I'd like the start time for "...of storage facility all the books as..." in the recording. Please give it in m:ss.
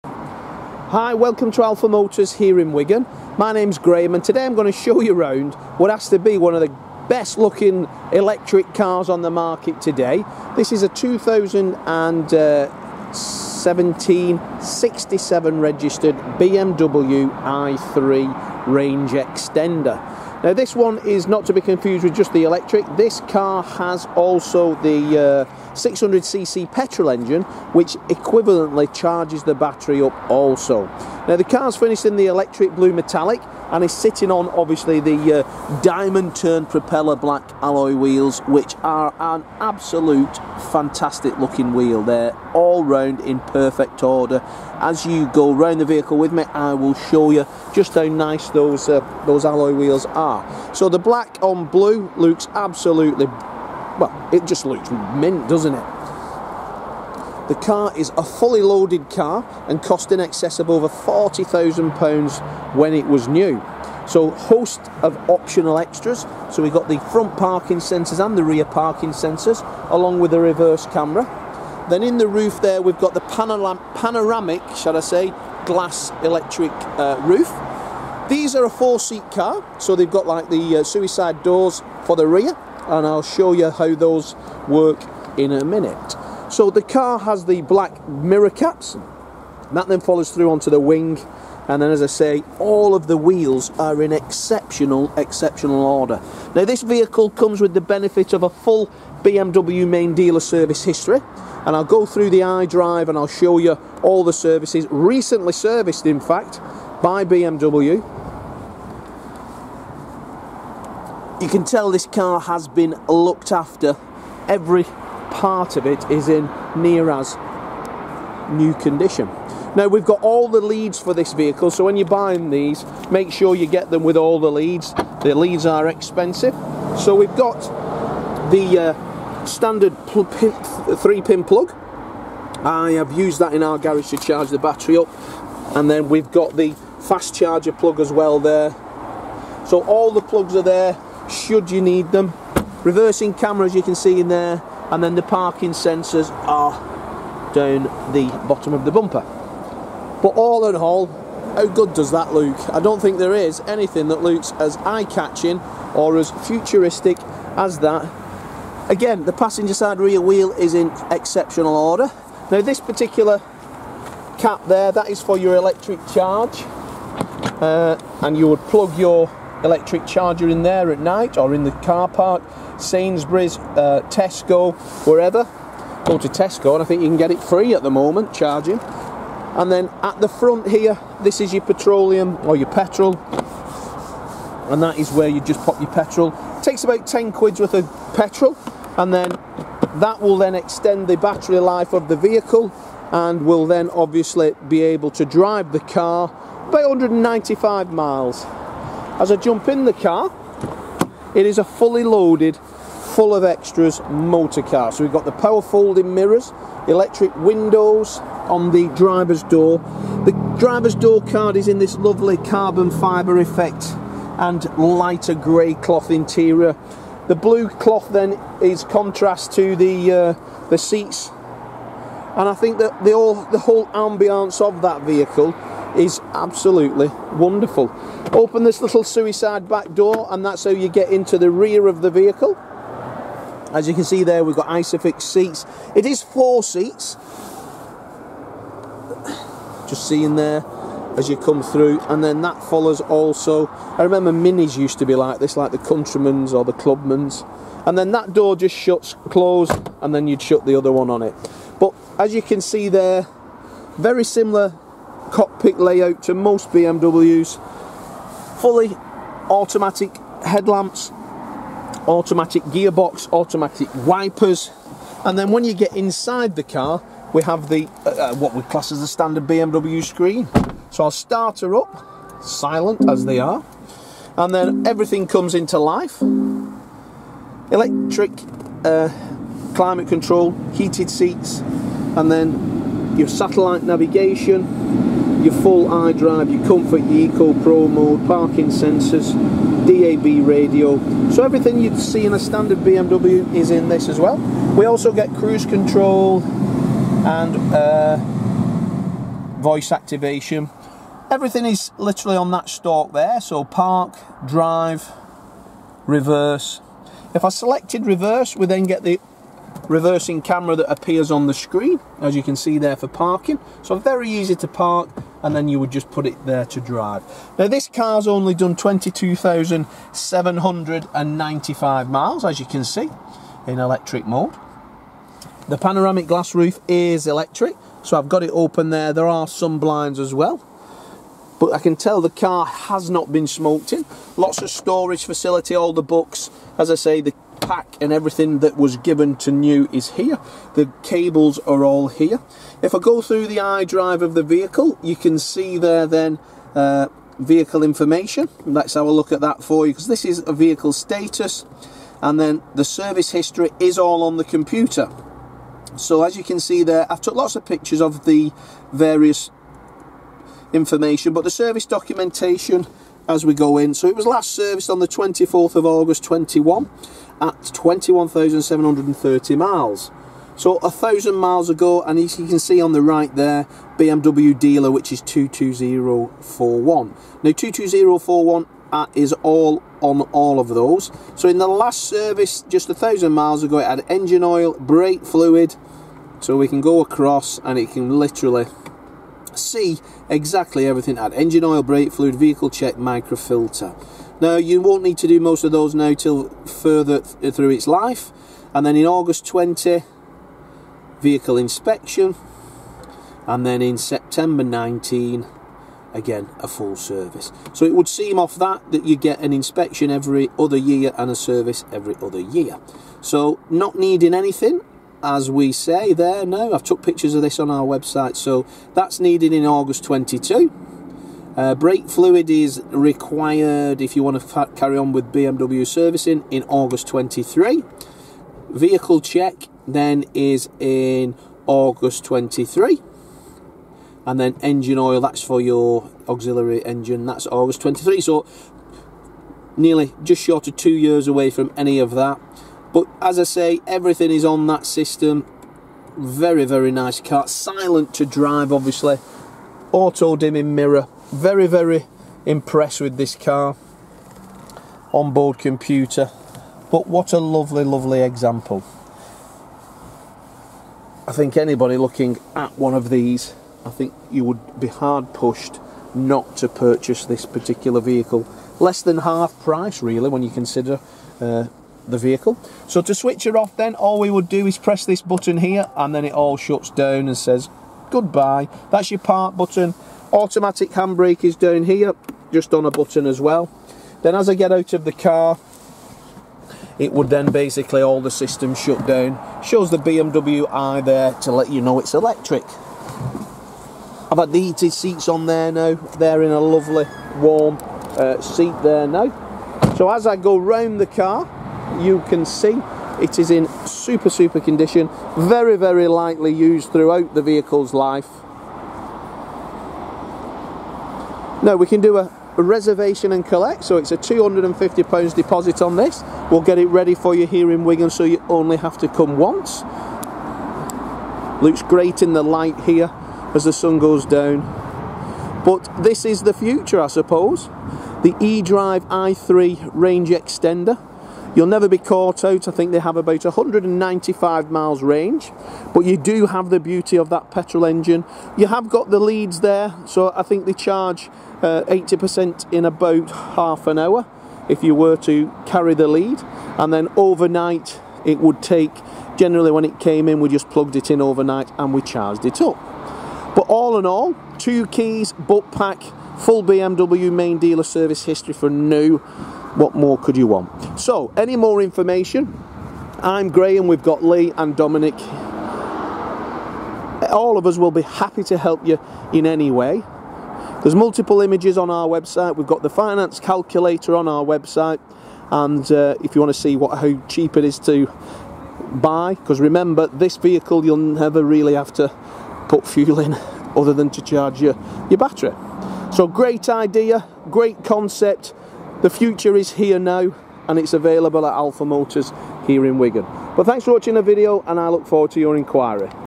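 5:34.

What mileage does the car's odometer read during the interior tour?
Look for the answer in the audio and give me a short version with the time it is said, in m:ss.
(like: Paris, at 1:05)
22,795, at 5:18.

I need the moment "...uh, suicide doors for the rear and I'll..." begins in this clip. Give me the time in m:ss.
1:20.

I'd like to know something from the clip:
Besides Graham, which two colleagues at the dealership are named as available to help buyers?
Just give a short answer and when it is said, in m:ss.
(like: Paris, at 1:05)
Lee and Dominic, at 9:24.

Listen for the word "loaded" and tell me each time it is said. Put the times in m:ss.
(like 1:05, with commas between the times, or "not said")
0:58, 3:22.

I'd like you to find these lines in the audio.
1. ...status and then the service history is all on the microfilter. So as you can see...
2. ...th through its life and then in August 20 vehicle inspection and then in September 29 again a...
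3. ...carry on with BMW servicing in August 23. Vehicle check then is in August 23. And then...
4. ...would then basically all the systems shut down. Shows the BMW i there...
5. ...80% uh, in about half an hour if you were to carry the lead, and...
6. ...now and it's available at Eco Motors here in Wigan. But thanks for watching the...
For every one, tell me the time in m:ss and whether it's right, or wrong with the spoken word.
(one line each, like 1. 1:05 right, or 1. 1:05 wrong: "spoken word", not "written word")
1. 5:50 wrong: "computer", not "microfilter"
2. 6:37 wrong: "19", not "29"
3. 7:04 right
4. 8:07 right
5. 9:01 right
6. 9:49 wrong: "Alpha", not "Eco".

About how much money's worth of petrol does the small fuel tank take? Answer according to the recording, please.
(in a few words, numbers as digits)
£10.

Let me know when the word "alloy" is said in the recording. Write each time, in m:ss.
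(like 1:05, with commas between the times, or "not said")
0:37, 0:49.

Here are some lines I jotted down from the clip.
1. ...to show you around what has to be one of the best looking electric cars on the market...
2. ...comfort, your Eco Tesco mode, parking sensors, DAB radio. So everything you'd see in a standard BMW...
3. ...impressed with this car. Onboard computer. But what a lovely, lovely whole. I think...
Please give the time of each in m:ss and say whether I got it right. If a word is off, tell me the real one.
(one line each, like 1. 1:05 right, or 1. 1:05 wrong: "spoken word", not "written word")
1. 0:04 right
2. 4:46 wrong: "Pro", not "Tesco"
3. 7:32 wrong: "example", not "whole".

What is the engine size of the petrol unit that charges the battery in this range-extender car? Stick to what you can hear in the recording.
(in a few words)
600cc.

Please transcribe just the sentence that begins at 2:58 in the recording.
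And then at the front here, this is your petroleum or your petrol.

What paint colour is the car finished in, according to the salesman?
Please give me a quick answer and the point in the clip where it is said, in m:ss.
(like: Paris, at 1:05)
electric blue metallic, at 0:32.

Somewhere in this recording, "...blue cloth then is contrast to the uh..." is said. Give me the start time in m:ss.
3:37.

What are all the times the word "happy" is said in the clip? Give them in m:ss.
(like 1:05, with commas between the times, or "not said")
9:28.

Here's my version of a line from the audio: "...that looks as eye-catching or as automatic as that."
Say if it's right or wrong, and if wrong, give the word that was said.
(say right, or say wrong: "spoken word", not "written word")
wrong: "futuristic", not "automatic".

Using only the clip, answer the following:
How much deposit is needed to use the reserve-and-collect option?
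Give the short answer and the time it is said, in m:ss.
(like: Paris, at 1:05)
£250, at 8:34.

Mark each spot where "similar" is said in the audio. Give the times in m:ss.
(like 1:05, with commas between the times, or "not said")
4:14.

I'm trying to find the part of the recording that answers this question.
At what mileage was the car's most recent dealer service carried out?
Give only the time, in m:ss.
6:07.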